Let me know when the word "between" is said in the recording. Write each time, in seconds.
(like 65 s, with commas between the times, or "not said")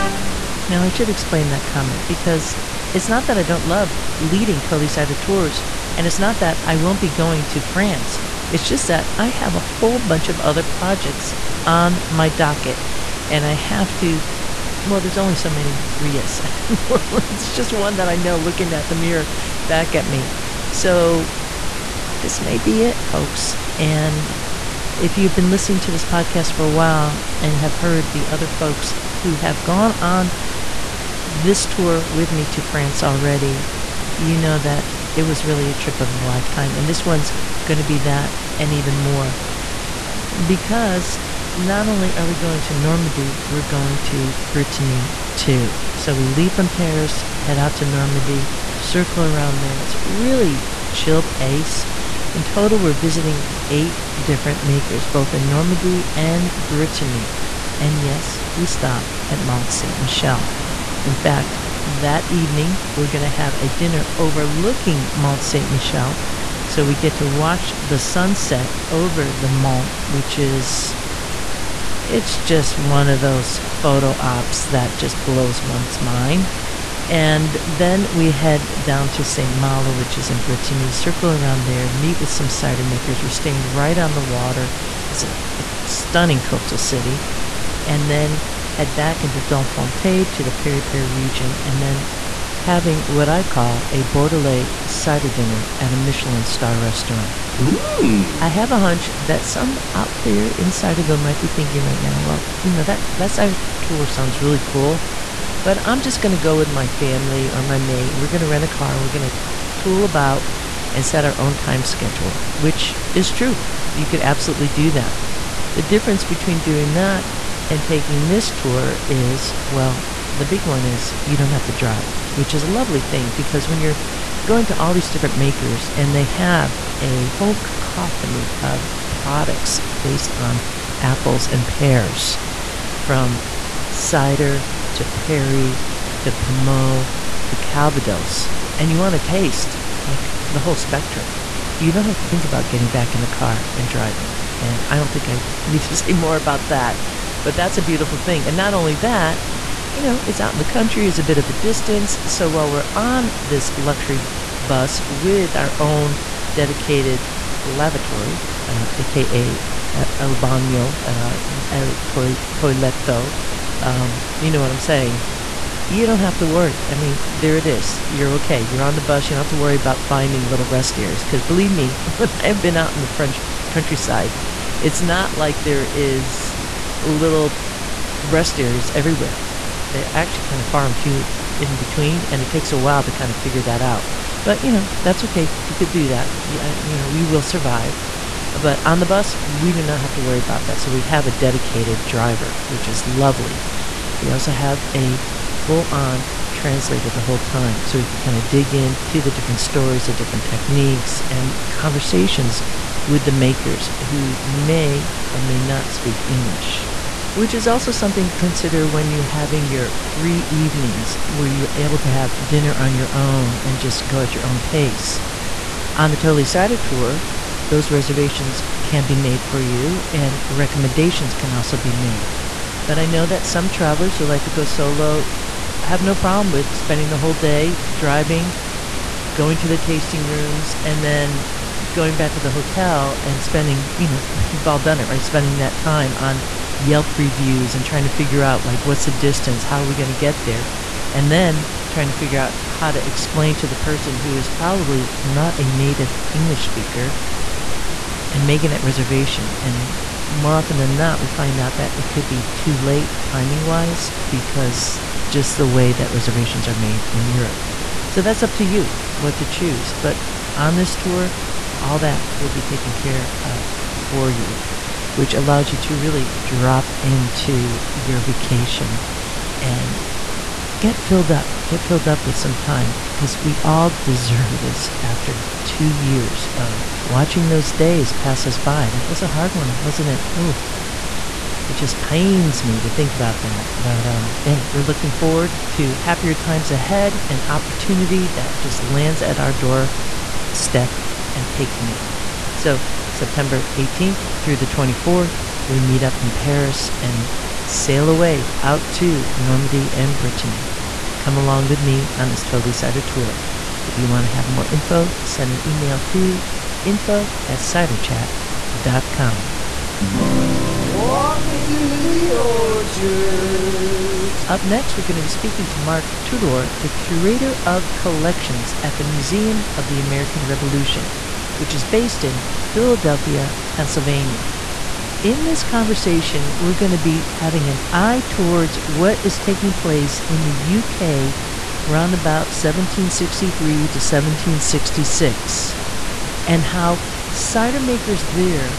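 116 s, 181 s.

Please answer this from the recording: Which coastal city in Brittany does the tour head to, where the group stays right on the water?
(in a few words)
St. Malo.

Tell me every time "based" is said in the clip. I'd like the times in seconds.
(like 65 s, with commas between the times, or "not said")
130 s, 321 s.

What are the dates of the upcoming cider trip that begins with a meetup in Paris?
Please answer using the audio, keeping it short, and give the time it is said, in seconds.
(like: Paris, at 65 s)
September 18th through 24th, at 293 s.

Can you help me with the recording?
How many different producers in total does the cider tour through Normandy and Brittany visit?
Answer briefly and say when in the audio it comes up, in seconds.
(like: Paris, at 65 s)
8, at 53 s.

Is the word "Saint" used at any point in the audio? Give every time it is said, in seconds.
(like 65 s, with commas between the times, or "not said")
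59 s, 65 s.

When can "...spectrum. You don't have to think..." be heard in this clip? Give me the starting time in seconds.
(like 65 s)
140 s.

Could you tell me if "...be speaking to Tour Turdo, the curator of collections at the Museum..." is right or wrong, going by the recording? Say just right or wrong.
wrong.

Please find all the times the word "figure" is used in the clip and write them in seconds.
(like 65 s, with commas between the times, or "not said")
183 s, 238 s, 242 s.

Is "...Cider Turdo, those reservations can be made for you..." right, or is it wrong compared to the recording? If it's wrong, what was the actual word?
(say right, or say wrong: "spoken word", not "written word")
wrong: "Tour", not "Turdo".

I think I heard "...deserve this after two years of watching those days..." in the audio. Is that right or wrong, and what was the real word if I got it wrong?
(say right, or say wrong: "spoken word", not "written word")
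right.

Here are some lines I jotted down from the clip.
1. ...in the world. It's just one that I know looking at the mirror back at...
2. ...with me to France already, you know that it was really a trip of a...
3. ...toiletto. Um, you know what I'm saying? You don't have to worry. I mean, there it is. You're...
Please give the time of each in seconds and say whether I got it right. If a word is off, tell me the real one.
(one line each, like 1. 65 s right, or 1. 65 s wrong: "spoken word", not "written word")
1. 16 s right
2. 32 s right
3. 162 s right.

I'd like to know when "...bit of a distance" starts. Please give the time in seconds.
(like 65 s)
151 s.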